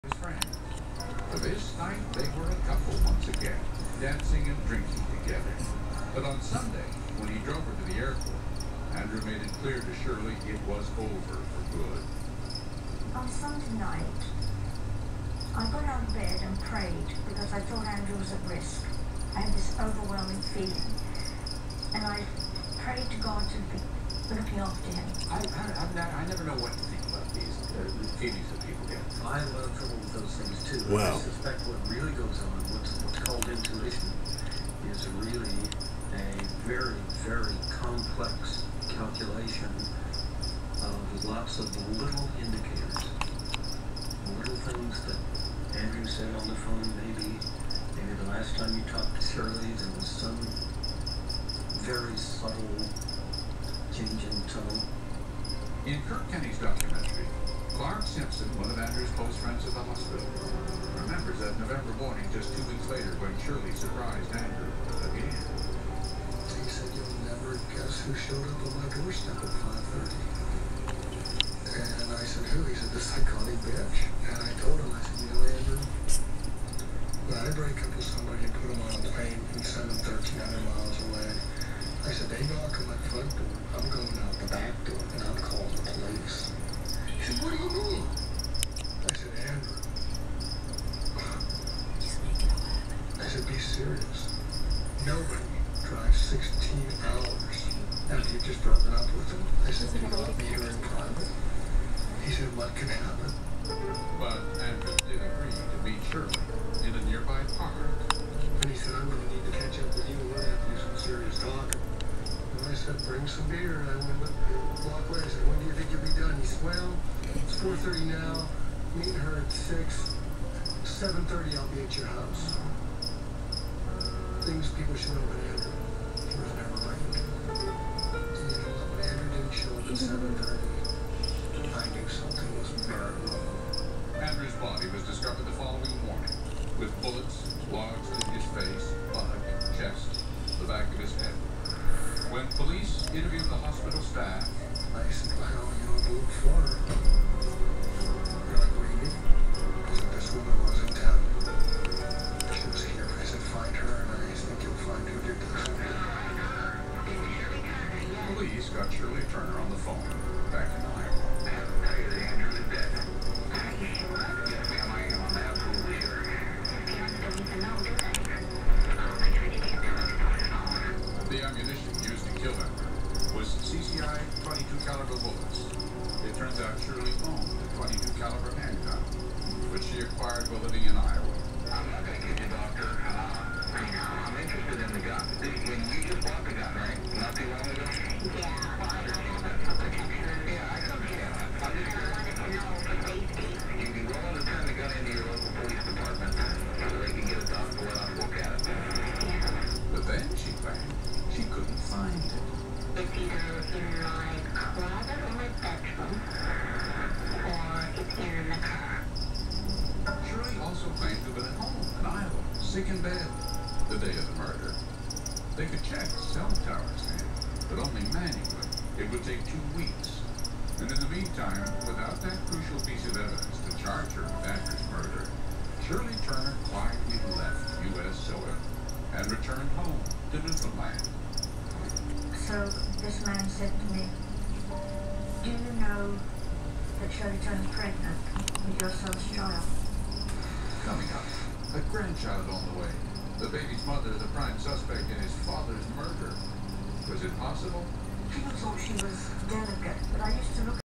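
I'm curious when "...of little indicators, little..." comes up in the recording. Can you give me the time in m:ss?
0:41.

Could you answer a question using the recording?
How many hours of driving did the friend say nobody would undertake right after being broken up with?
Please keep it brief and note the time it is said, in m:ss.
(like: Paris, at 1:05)
16, at 1:36.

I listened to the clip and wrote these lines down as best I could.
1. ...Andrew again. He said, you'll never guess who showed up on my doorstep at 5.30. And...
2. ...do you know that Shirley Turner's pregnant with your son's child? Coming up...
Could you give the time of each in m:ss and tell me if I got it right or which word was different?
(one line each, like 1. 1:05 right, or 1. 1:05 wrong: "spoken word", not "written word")
1. 1:04 right
2. 3:55 right.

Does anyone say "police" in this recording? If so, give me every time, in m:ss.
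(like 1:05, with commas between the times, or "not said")
1:25, 2:38.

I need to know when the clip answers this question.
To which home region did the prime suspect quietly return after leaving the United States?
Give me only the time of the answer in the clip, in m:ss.
3:50.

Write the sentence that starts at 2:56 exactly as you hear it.
It turns out Shirley owned a 22 caliber handgun, which she acquired while living in Iowa.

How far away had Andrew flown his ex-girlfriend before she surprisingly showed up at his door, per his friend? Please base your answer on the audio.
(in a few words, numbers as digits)
1,300 miles.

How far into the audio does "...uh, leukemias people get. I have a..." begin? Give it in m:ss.
0:27.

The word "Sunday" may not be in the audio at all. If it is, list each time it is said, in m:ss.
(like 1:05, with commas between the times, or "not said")
0:06, 0:13.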